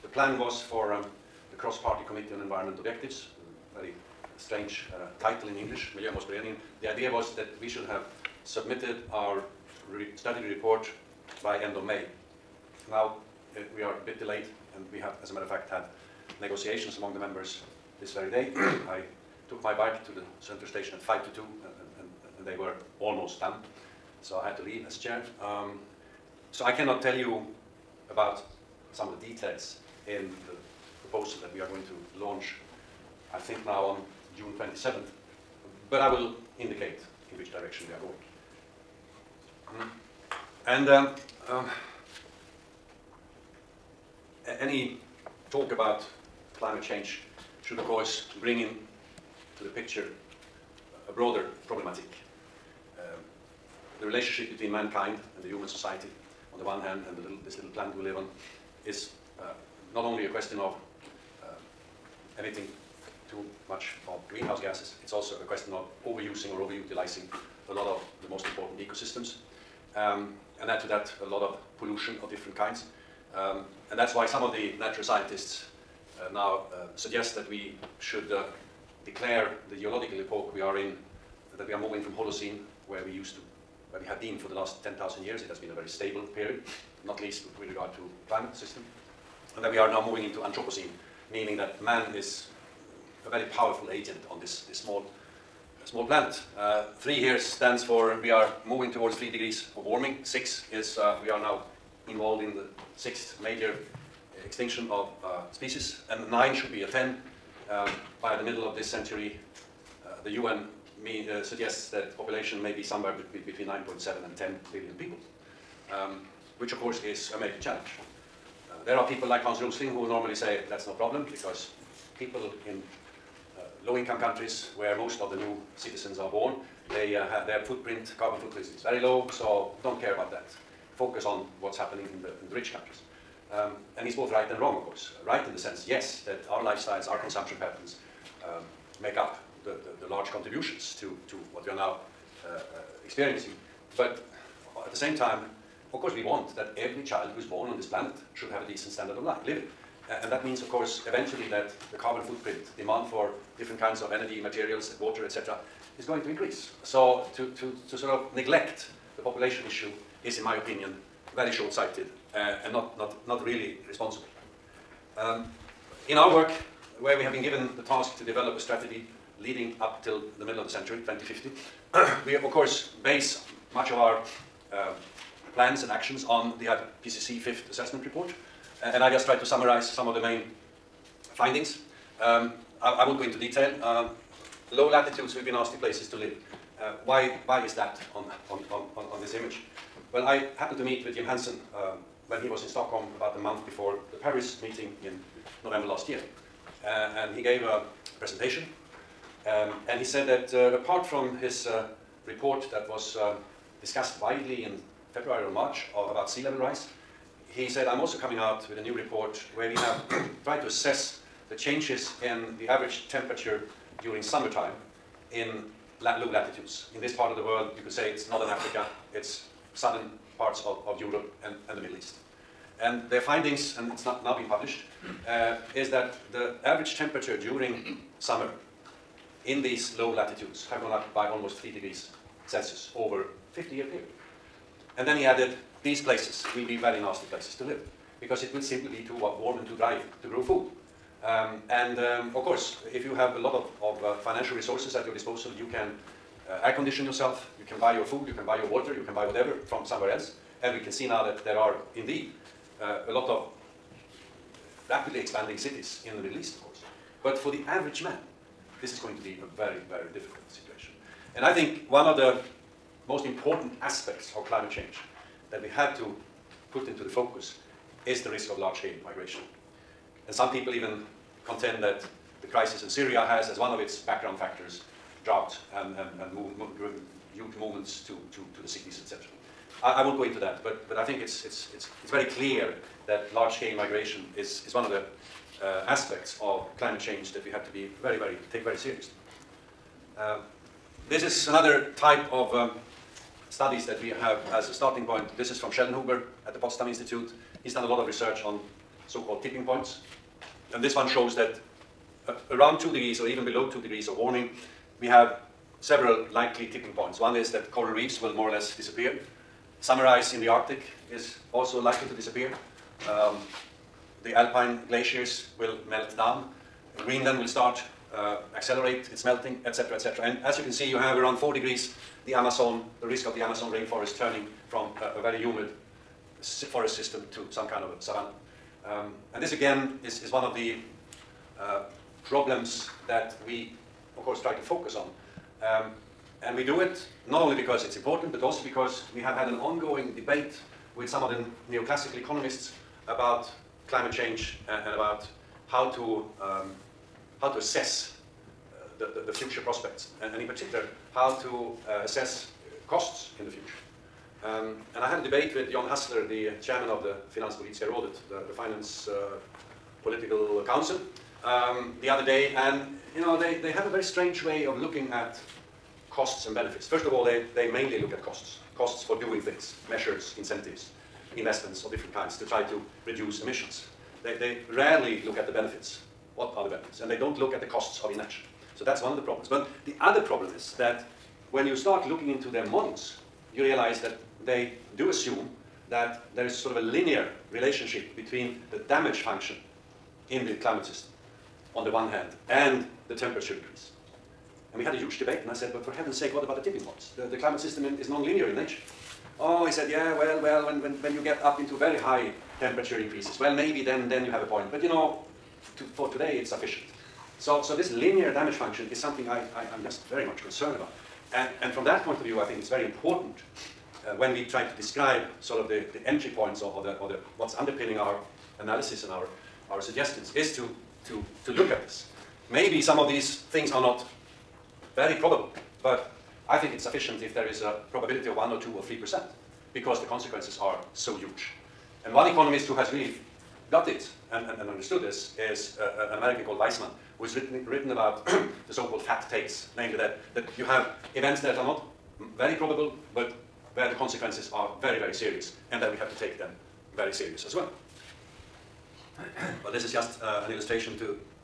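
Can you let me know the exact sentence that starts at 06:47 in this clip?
So, so this linear damage function is something I, I, am just very much concerned about.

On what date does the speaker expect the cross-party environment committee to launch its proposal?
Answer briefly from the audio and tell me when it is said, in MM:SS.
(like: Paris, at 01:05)
June 27th, at 00:34.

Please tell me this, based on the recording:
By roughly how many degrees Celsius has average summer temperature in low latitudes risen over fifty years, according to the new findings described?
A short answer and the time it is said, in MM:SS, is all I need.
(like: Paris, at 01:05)
almost 3 degrees, at 03:51.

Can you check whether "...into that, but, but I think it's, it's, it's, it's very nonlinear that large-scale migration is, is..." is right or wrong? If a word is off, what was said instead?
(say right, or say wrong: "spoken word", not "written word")
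wrong: "clear", not "nonlinear".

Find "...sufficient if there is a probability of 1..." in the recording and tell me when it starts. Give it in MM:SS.
07:06.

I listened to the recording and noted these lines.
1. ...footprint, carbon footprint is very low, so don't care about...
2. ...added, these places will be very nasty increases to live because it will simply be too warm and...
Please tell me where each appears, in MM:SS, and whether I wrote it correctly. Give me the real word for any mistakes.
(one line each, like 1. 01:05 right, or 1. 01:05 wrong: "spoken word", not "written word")
1. 02:07 right
2. 03:55 wrong: "places", not "increases".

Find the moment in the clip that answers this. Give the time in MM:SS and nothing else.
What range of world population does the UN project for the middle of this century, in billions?
01:53.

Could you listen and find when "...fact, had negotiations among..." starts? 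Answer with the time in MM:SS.
00:15.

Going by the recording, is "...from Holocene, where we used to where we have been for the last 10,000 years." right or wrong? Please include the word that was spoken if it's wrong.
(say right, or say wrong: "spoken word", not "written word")
right.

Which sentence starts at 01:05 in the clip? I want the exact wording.
It's also a question of overusing or overutilizing a lot of the most important ecosystems.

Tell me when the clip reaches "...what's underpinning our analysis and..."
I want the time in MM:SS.
06:57.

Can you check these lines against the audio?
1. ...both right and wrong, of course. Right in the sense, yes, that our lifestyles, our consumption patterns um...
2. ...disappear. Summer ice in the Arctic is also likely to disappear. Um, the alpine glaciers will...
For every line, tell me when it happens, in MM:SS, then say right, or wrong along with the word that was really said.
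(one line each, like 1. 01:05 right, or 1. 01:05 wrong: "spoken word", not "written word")
1. 02:14 right
2. 05:08 right.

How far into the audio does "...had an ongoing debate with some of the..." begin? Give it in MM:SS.
05:39.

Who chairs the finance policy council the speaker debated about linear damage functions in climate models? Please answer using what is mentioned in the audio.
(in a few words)
Jan Hassler.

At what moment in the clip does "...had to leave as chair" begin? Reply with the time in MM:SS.
00:24.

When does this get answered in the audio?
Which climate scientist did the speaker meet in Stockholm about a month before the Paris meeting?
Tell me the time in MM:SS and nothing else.
03:11.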